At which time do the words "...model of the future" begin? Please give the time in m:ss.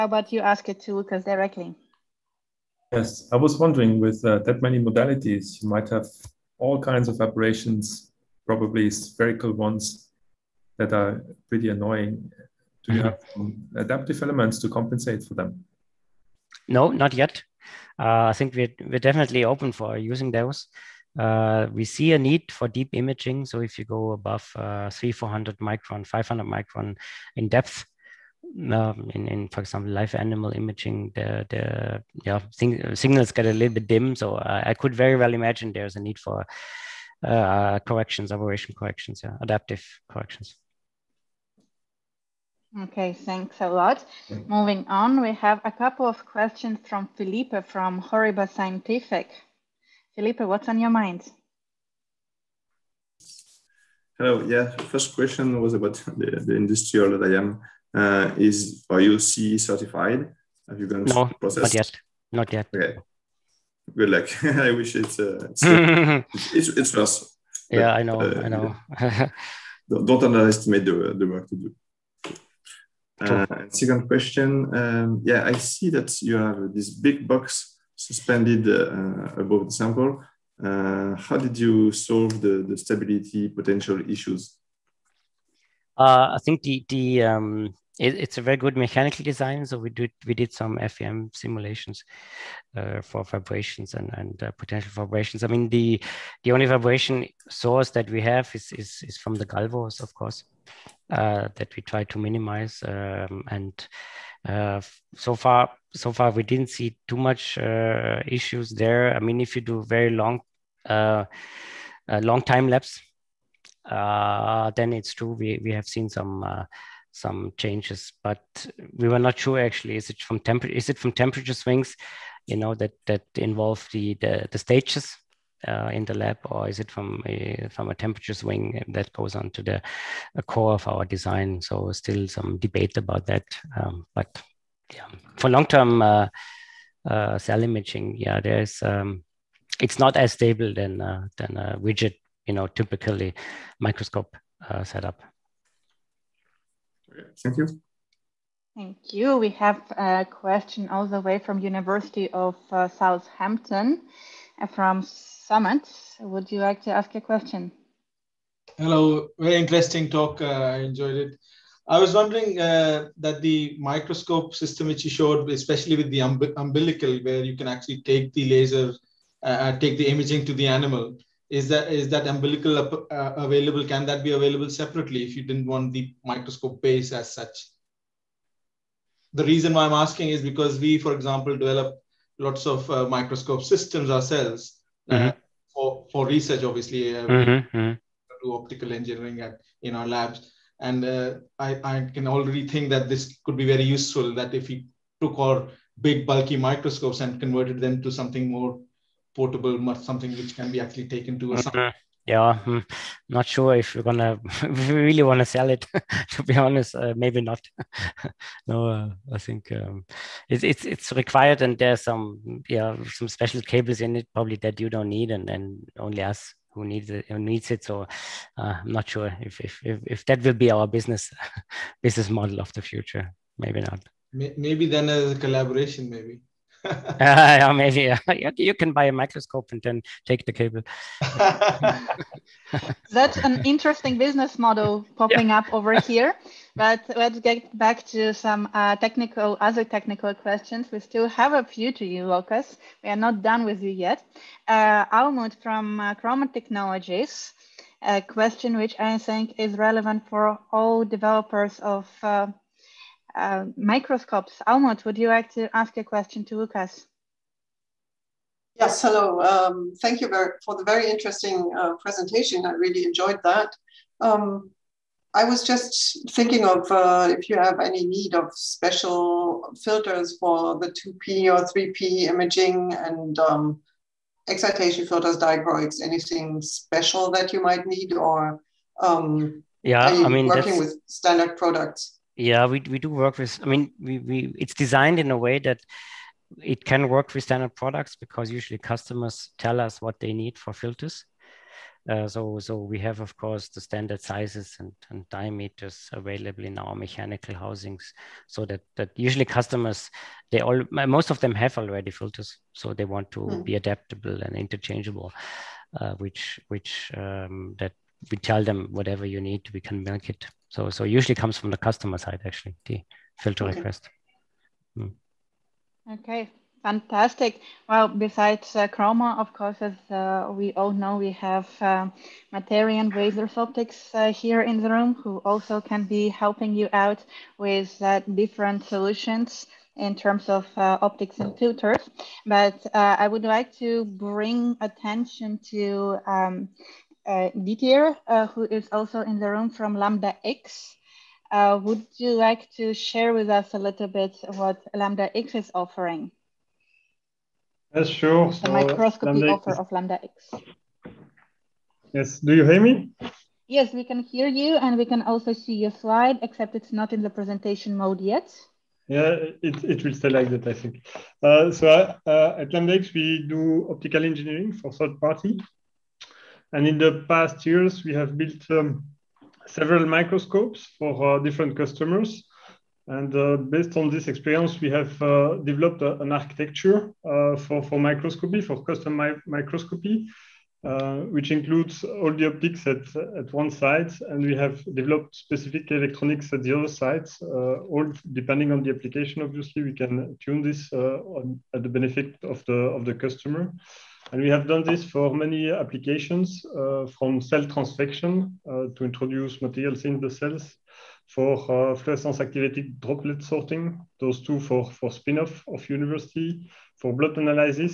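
3:42.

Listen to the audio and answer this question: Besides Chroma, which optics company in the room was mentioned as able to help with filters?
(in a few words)
Materion Balzers Optics.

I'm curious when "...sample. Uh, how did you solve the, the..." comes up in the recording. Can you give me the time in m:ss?
1:19.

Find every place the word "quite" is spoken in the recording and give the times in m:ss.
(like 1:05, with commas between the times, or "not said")
not said.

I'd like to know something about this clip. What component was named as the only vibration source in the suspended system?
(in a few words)
the galvos.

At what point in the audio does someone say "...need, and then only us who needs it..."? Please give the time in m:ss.
3:35.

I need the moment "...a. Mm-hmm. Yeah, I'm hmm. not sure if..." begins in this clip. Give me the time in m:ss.
3:21.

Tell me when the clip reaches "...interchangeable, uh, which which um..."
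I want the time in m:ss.
5:04.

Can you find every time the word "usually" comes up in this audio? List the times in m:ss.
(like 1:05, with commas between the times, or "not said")
4:48, 4:59, 5:11.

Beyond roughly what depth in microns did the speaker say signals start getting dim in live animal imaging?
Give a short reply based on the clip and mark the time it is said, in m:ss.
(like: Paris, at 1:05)
500 microns, at 0:26.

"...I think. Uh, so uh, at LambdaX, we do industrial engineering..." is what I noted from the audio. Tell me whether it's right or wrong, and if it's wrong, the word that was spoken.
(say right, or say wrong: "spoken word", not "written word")
wrong: "optical", not "industrial".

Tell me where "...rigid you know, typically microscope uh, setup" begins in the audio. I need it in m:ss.
2:21.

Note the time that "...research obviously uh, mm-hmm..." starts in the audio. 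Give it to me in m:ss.
3:06.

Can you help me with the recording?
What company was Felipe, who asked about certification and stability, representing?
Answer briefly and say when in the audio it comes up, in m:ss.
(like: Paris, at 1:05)
Horiba Scientific, at 0:47.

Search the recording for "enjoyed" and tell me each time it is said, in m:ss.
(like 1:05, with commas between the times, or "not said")
2:40, 4:23.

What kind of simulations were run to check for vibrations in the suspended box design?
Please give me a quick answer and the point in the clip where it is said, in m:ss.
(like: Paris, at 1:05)
FEM simulations, at 1:30.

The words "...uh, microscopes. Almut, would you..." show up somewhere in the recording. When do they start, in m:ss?
4:13.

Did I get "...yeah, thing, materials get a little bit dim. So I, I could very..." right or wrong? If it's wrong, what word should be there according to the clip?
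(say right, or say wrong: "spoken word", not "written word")
wrong: "signals", not "materials".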